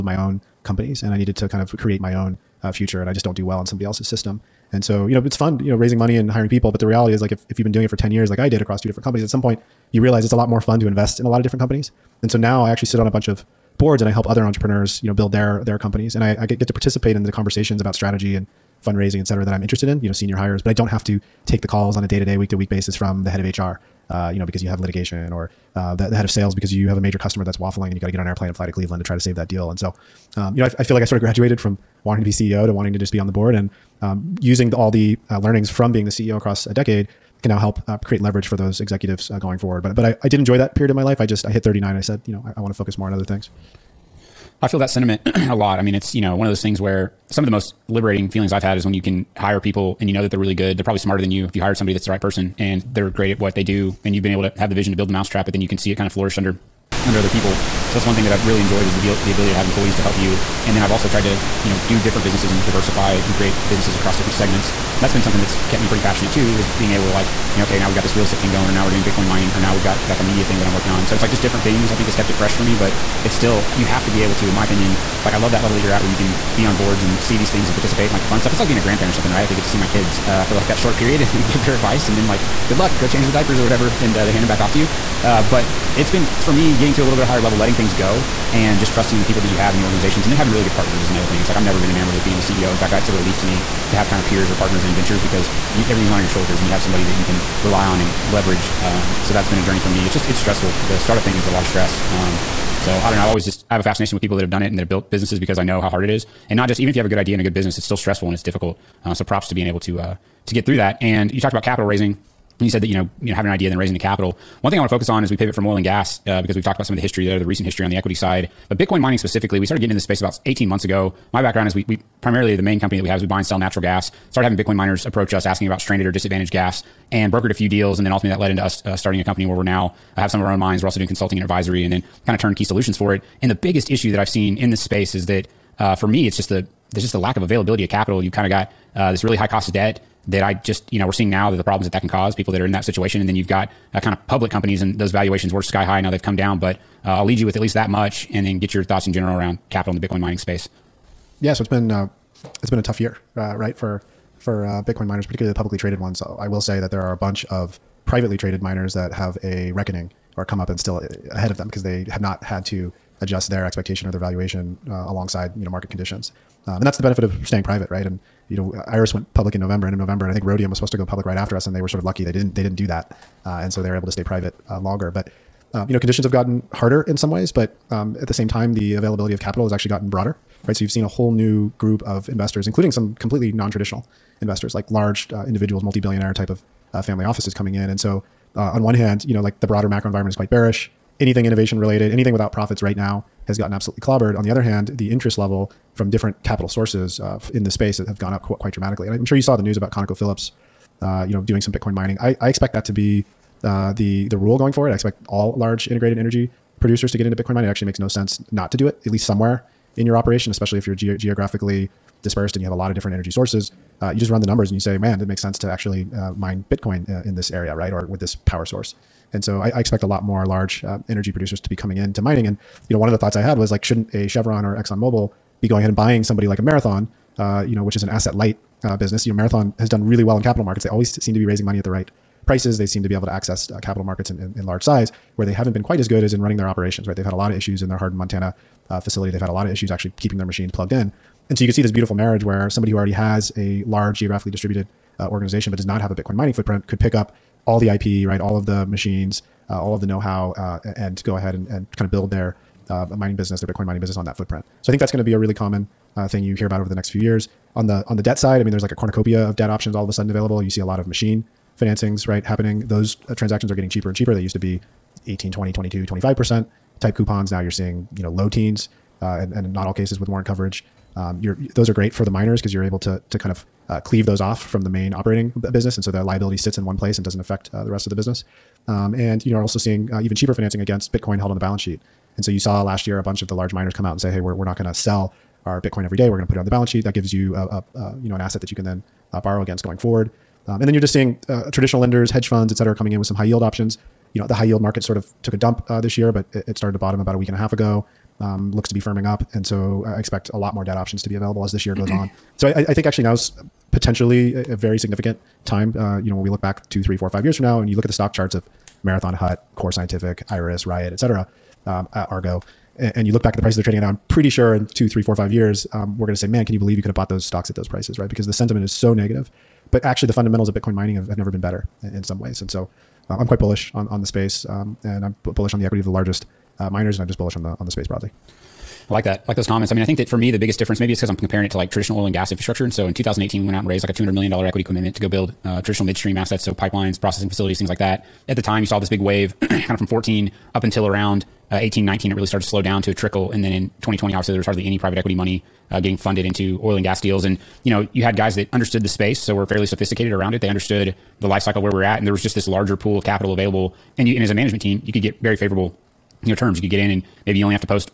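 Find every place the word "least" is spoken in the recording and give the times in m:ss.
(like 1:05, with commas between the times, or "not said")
2:27, 3:29.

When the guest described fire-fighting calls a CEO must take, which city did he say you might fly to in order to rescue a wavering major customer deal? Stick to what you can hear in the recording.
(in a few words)
Cleveland.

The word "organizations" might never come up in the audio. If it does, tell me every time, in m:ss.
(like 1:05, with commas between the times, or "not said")
1:29, 4:05.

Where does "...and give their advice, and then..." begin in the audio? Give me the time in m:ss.
1:21.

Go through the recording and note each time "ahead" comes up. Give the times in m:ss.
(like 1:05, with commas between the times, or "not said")
2:41, 3:45, 4:11.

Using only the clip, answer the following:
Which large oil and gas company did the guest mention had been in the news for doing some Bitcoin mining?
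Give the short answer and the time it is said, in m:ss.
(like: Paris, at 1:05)
ConocoPhillips, at 3:19.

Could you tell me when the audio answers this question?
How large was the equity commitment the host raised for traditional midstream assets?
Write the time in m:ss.
5:34.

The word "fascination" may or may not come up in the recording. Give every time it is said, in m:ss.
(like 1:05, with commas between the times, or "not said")
1:43.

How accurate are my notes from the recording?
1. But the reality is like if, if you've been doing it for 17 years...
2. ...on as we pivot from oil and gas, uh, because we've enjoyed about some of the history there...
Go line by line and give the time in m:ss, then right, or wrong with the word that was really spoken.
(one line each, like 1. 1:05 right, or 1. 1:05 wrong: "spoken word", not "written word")
1. 0:06 wrong: "10", not "17"
2. 1:55 wrong: "talked", not "enjoyed".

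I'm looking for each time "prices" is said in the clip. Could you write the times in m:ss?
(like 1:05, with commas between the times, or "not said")
3:52, 5:13, 5:17.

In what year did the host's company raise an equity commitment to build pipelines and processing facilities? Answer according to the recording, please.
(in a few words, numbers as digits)
2018.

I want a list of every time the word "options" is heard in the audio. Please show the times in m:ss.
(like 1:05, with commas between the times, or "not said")
4:19, 4:53, 5:00.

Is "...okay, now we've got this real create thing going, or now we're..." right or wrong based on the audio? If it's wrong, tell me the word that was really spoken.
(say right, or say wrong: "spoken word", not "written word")
wrong: "estate", not "create".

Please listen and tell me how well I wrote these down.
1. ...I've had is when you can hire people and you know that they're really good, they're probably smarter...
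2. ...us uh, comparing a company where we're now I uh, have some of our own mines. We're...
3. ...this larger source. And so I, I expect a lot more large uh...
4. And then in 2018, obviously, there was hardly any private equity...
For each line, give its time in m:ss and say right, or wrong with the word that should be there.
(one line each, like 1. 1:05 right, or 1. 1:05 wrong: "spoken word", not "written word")
1. 0:48 right
2. 2:08 wrong: "starting", not "comparing"
3. 3:38 wrong: "power", not "larger"
4. 5:43 wrong: "2020", not "2018".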